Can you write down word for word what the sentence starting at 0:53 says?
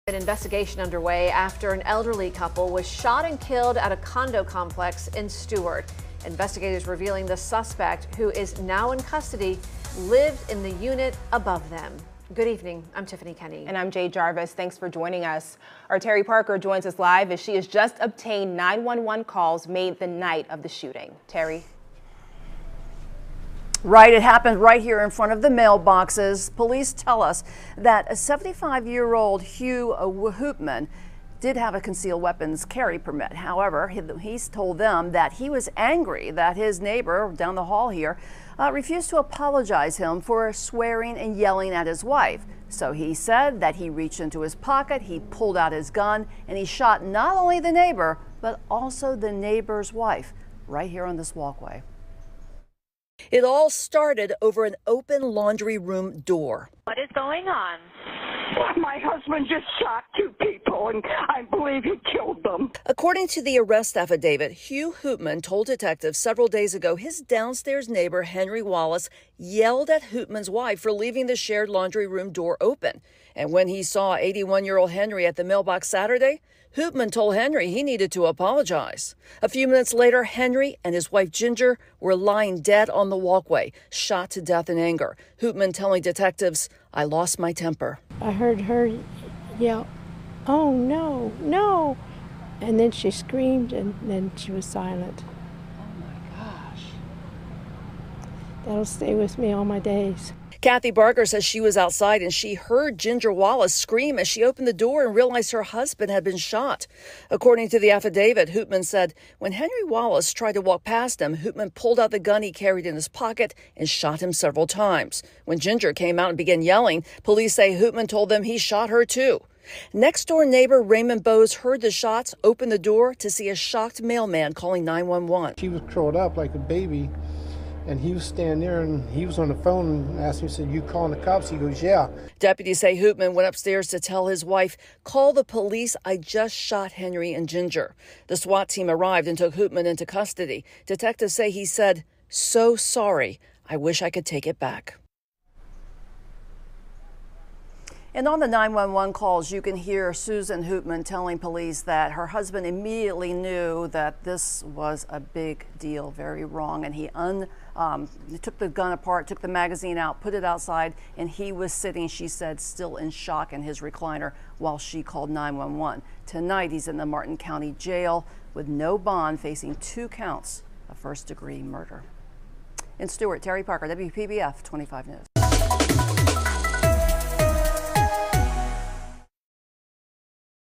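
It all started over an open laundry room door.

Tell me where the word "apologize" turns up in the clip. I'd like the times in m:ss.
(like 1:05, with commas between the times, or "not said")
0:39, 1:18.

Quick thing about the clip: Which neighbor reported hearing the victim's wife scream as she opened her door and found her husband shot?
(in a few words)
Kathy Barker.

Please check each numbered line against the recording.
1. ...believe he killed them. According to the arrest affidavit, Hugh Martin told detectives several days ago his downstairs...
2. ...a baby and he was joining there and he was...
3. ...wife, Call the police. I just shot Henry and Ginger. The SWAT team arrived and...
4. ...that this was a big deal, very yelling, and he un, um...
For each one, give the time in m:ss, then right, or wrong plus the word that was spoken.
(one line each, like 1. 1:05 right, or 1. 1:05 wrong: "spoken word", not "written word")
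1. 1:01 wrong: "Hoopman", not "Martin"
2. 2:06 wrong: "standing", not "joining"
3. 2:14 right
4. 2:33 wrong: "wrong", not "yelling".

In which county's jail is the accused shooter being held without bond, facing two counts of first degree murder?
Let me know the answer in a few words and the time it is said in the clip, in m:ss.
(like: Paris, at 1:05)
Martin County, at 2:47.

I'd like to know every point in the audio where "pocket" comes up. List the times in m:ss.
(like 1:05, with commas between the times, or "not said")
0:44, 1:53.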